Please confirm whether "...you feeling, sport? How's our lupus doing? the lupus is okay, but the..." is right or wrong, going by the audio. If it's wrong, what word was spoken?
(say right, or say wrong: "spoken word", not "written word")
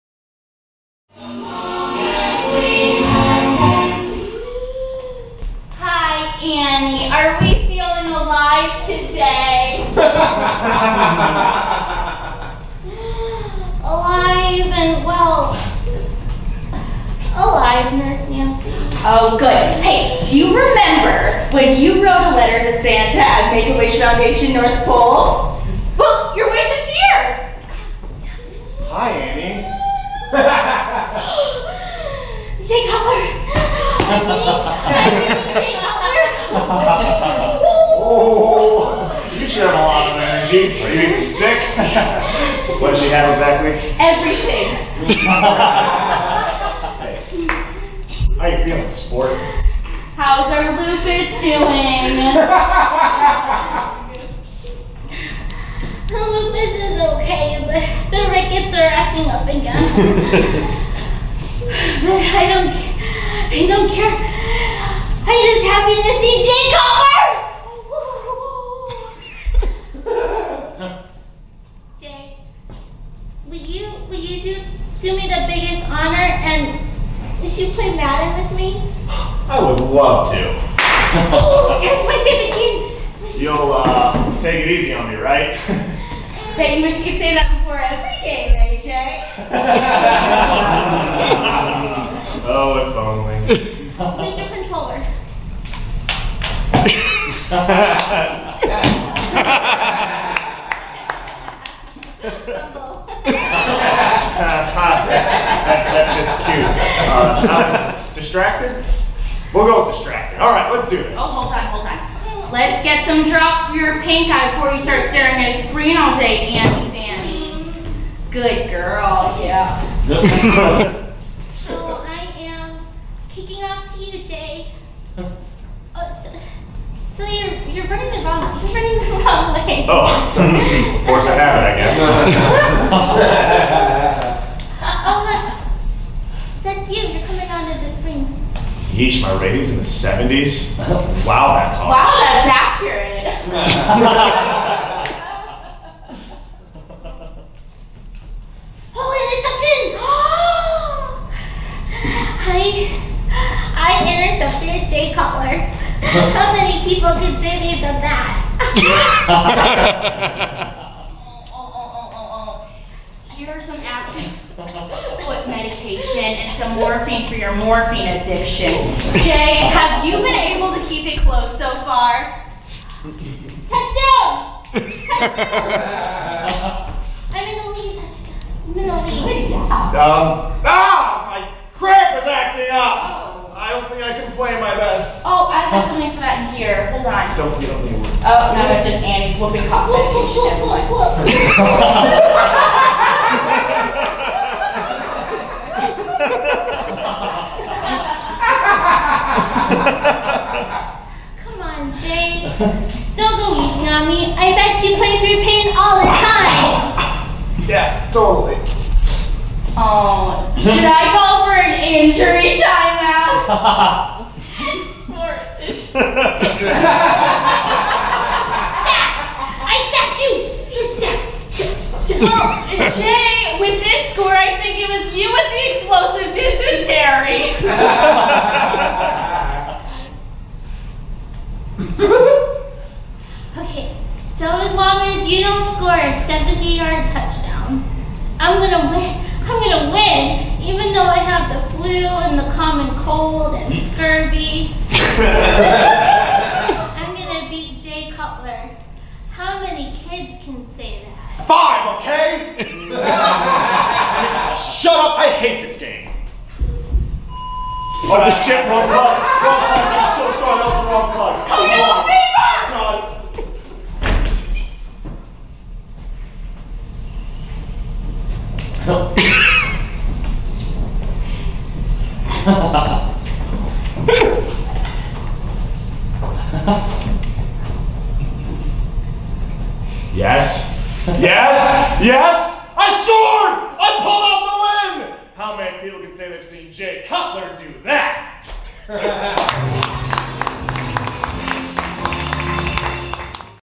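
right.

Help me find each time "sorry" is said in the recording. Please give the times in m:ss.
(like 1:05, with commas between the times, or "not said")
2:10, 4:20.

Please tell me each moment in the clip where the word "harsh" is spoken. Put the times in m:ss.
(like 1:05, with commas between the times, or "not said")
2:21.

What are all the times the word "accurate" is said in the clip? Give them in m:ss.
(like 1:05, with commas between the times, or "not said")
2:22.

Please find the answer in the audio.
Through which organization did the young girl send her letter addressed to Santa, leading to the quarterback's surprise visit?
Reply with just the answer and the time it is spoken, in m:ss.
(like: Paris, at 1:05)
Make-A-Wish Foundation, at 0:23.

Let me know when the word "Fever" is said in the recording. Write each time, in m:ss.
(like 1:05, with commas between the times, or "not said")
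4:22.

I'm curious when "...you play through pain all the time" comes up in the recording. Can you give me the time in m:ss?
3:24.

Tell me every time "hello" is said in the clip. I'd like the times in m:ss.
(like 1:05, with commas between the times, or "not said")
not said.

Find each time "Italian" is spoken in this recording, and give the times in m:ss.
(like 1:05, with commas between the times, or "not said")
not said.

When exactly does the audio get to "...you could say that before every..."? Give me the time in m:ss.
1:26.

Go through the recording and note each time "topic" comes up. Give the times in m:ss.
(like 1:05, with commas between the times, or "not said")
not said.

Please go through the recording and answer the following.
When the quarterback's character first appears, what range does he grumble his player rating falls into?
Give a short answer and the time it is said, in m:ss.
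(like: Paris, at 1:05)
70s, at 2:19.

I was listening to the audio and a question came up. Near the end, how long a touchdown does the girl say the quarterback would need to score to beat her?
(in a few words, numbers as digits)
70-yard.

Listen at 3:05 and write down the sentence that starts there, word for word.
Oh, have something for that in here.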